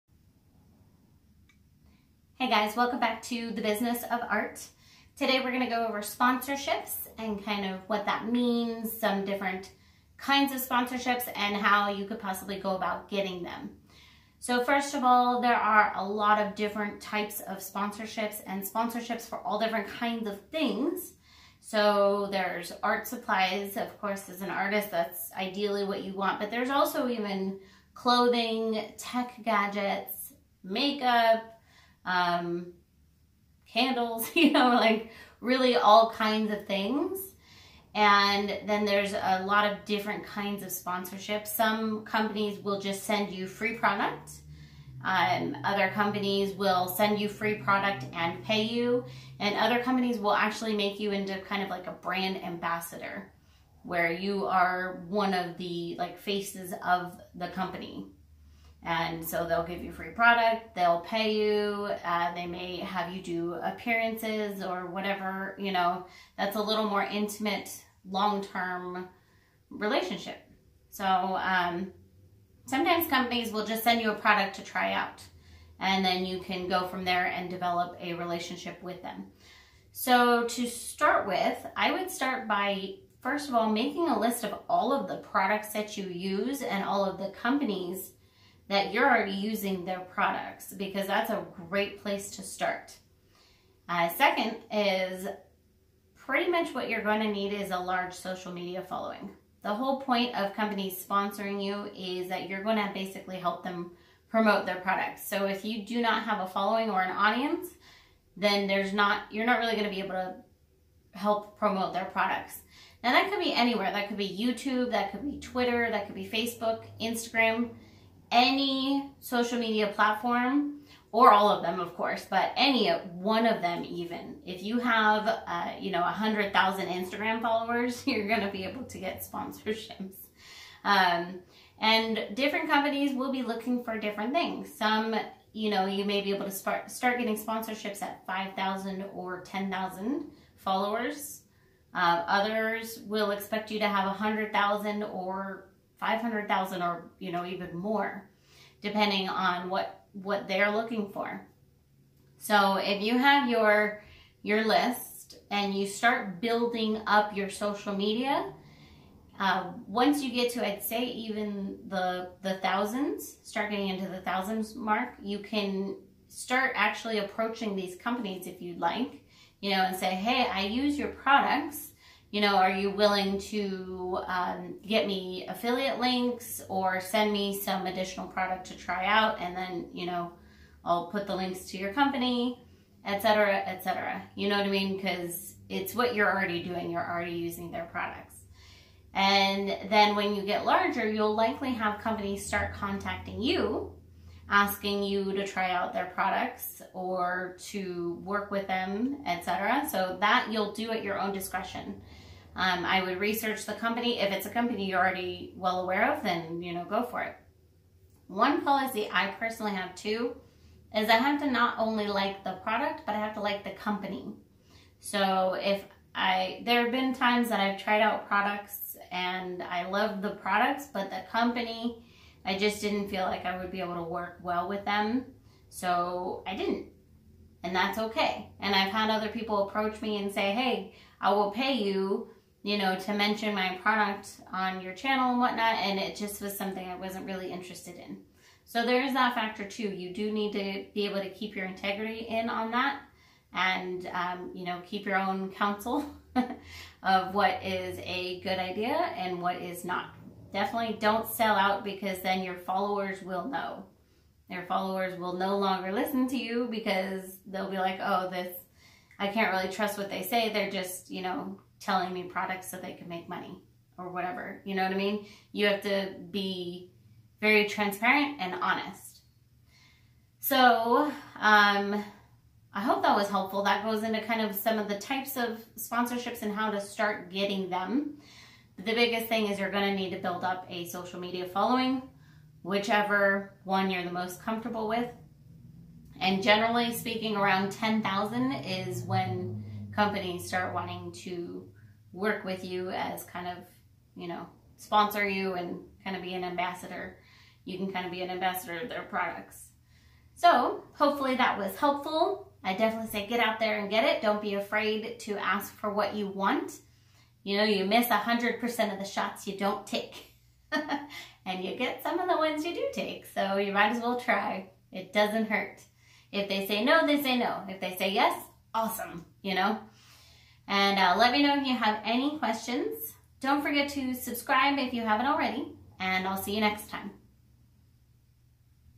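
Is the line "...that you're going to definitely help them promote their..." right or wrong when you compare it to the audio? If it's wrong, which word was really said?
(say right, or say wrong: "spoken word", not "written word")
wrong: "basically", not "definitely".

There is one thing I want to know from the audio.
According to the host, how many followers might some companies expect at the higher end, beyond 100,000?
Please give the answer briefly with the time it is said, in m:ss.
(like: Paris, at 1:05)
500,000, at 2:26.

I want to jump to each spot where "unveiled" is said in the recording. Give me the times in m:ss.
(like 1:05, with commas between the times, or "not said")
not said.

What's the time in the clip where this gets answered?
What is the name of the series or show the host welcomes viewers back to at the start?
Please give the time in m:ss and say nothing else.
0:03.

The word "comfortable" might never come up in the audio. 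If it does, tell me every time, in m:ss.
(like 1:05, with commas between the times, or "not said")
4:44.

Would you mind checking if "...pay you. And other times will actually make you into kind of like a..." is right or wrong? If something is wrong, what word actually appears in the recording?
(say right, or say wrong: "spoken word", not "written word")
wrong: "companies", not "times".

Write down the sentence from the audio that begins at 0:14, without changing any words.
So first of all, there are a lot of different types of sponsorships and sponsorships for all different kinds of things.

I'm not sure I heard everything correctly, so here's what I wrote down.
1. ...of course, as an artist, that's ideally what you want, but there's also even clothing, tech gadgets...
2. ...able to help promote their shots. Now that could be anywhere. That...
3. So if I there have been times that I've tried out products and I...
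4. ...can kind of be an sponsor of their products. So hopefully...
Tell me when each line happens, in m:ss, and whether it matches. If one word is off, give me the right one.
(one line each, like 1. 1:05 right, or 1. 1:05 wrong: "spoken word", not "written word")
1. 0:23 right
2. 1:49 wrong: "products", not "shots"
3. 3:34 right
4. 4:57 wrong: "ambassador", not "sponsor".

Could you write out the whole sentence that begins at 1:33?
Uh, second is pretty much what you're going to need is a large social media following.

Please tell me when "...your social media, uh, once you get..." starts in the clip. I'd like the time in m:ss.
2:37.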